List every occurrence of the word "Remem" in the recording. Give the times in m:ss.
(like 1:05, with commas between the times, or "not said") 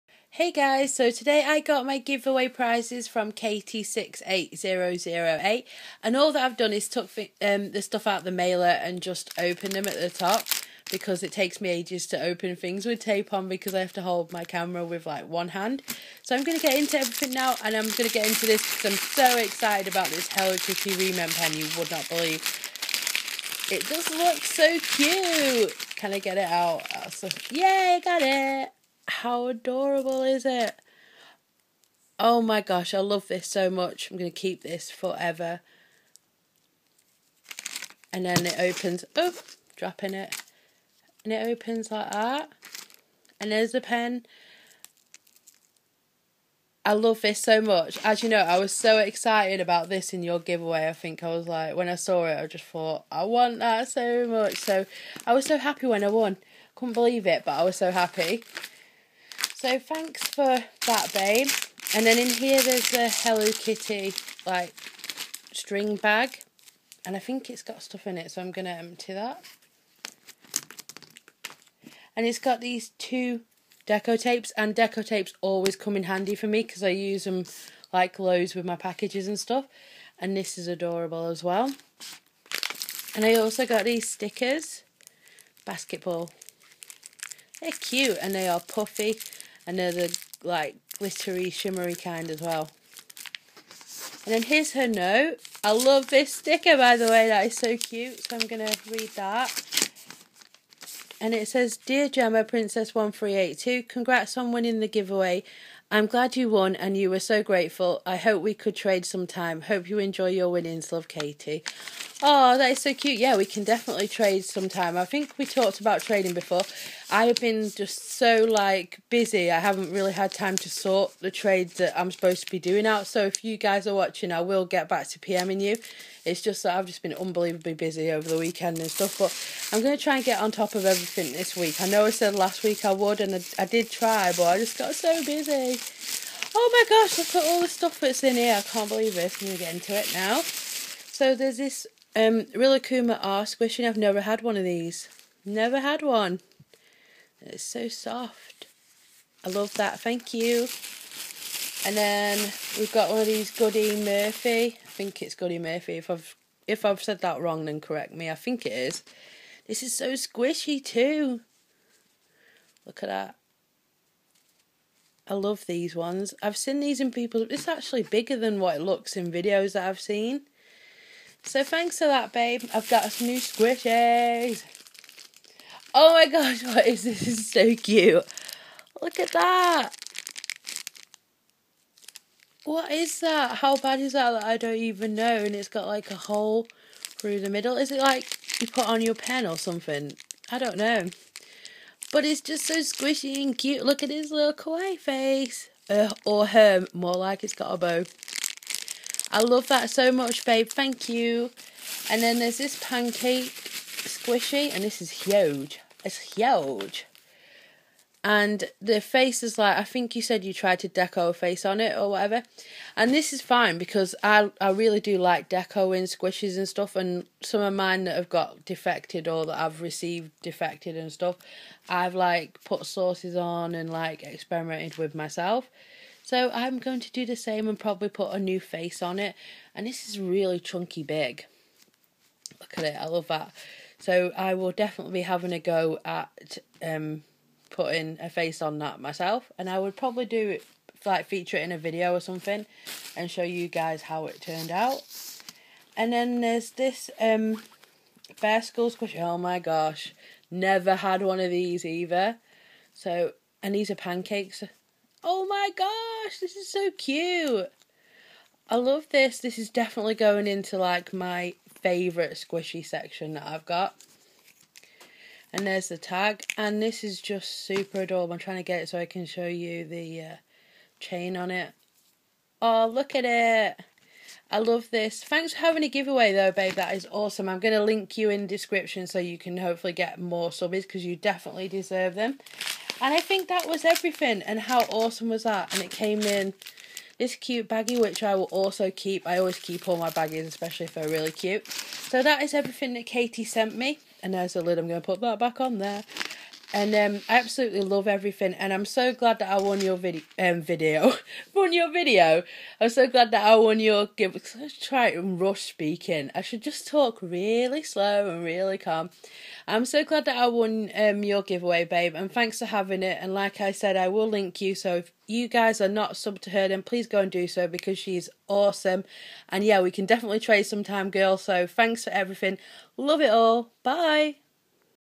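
0:20.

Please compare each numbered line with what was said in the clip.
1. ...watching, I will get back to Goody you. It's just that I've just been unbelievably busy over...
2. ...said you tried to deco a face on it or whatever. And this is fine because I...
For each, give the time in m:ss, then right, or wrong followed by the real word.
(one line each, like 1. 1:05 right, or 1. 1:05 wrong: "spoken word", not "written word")
1. 2:03 wrong: "PMing", not "Goody"
2. 3:30 right.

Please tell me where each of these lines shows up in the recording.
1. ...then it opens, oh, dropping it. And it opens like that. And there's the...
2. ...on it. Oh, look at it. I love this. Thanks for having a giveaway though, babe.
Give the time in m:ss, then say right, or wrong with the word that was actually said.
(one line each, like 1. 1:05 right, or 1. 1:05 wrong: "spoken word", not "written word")
1. 0:38 right
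2. 4:31 right.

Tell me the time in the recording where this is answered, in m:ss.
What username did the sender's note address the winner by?
1:42.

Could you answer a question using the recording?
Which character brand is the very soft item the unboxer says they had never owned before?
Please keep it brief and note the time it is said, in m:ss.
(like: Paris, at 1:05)
Rilakuma, at 2:22.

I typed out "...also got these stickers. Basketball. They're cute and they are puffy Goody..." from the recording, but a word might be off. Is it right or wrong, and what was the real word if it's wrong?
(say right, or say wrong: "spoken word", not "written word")
wrong: "Another", not "Goody".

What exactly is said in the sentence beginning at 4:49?
I always keep all my baggies, especially if they're really cute.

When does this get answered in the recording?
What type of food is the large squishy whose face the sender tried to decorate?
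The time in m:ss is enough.
3:22.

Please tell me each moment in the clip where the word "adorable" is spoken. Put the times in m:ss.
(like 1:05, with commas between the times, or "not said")
0:29, 1:20, 4:28.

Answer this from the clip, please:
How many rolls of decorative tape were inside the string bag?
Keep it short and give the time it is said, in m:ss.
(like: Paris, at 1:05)
2, at 1:12.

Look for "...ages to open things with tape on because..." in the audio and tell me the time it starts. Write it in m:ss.
0:11.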